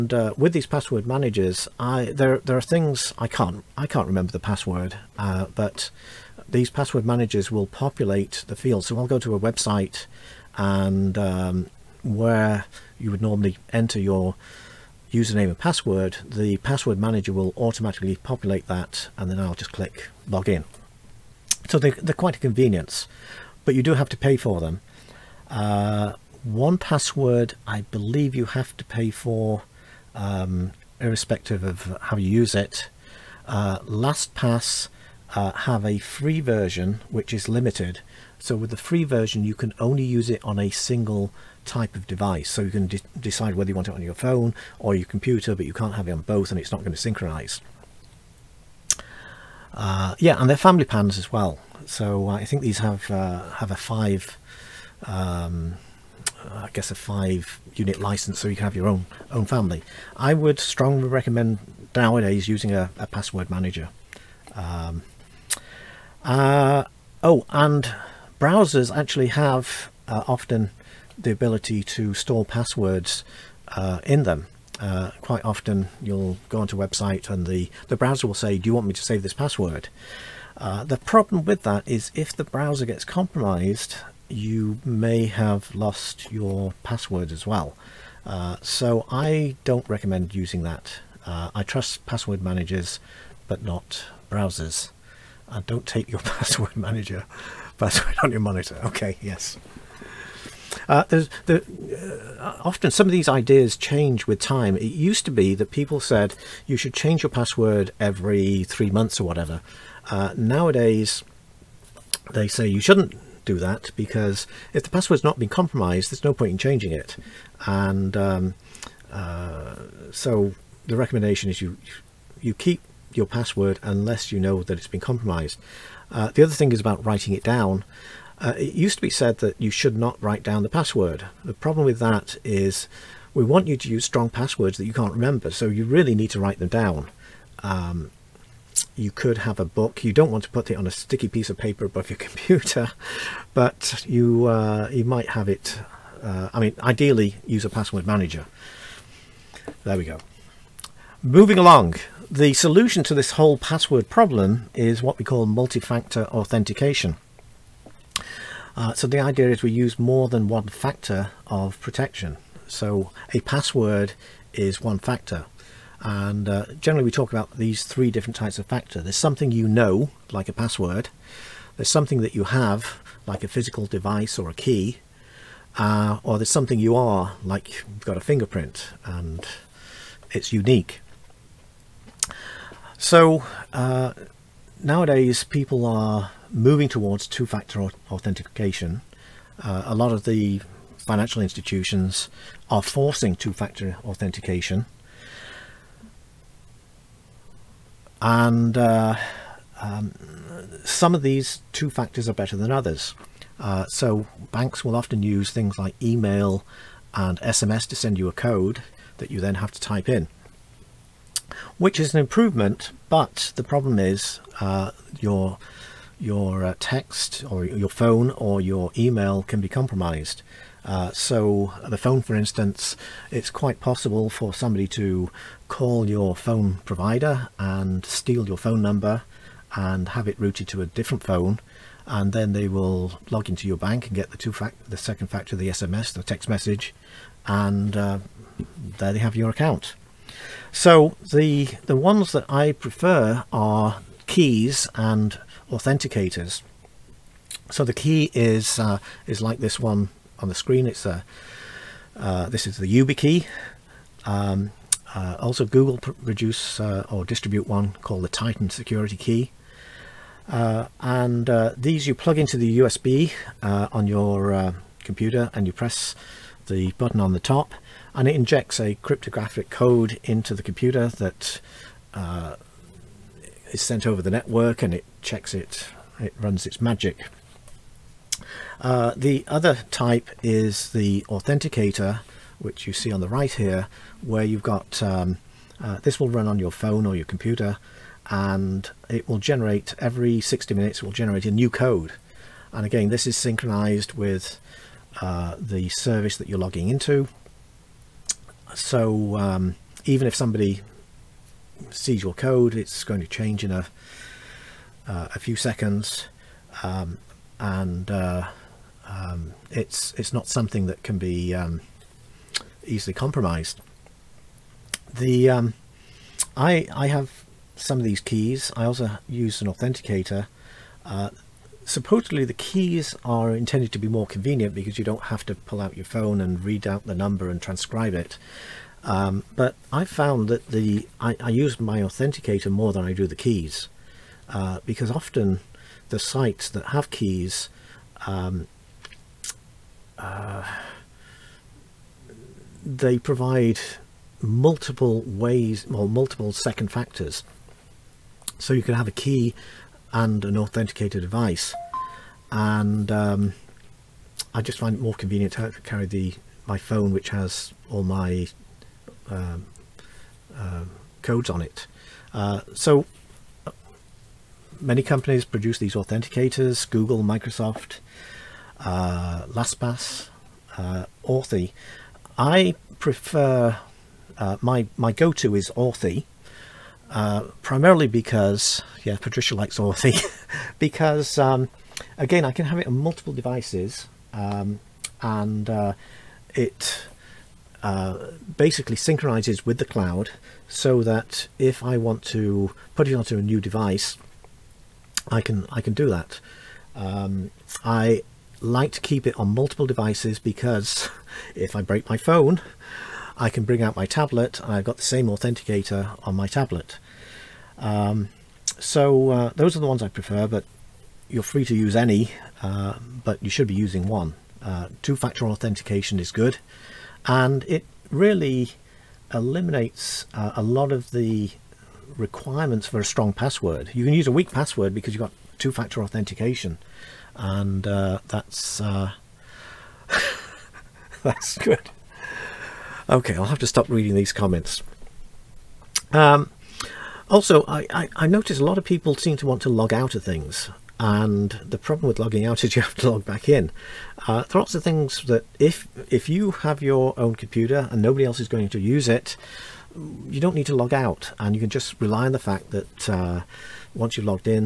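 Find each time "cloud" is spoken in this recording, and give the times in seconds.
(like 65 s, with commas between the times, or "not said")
389 s.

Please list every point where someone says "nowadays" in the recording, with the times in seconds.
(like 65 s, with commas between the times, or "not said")
61 s, 110 s, 184 s.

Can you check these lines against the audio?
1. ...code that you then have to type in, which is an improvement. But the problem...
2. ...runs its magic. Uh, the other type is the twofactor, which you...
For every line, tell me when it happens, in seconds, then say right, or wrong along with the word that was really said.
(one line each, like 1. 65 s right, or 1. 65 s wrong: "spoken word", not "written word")
1. 208 s right
2. 276 s wrong: "authenticator", not "twofactor".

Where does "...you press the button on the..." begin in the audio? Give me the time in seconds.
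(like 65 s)
265 s.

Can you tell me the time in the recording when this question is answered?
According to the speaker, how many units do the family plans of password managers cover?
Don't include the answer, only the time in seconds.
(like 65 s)
56 s.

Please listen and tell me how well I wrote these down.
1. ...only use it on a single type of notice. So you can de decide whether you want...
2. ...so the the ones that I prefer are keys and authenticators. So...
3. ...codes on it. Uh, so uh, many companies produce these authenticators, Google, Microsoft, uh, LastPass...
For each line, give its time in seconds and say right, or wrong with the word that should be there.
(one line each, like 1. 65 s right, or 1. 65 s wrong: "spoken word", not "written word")
1. 39 s wrong: "device", not "notice"
2. 240 s right
3. 361 s right.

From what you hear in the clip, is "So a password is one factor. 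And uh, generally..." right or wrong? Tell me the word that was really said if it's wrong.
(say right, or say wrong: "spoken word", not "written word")
right.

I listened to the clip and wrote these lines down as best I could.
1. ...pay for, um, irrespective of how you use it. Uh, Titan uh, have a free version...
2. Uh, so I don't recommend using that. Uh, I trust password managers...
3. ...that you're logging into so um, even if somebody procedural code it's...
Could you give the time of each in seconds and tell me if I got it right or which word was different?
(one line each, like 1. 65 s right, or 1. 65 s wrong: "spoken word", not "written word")
1. 28 s wrong: "LastPass", not "Titan"
2. 88 s right
3. 296 s right.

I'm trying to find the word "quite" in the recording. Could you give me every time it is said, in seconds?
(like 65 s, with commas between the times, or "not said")
22 s, 75 s, 223 s.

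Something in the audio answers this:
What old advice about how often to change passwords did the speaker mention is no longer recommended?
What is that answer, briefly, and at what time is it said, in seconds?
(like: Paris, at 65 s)
every three months, at 107 s.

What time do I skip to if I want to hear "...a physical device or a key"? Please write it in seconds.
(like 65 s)
173 s.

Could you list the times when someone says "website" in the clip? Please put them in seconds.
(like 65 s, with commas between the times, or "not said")
9 s, 76 s.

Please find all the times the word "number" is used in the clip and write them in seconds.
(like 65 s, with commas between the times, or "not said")
228 s, 327 s.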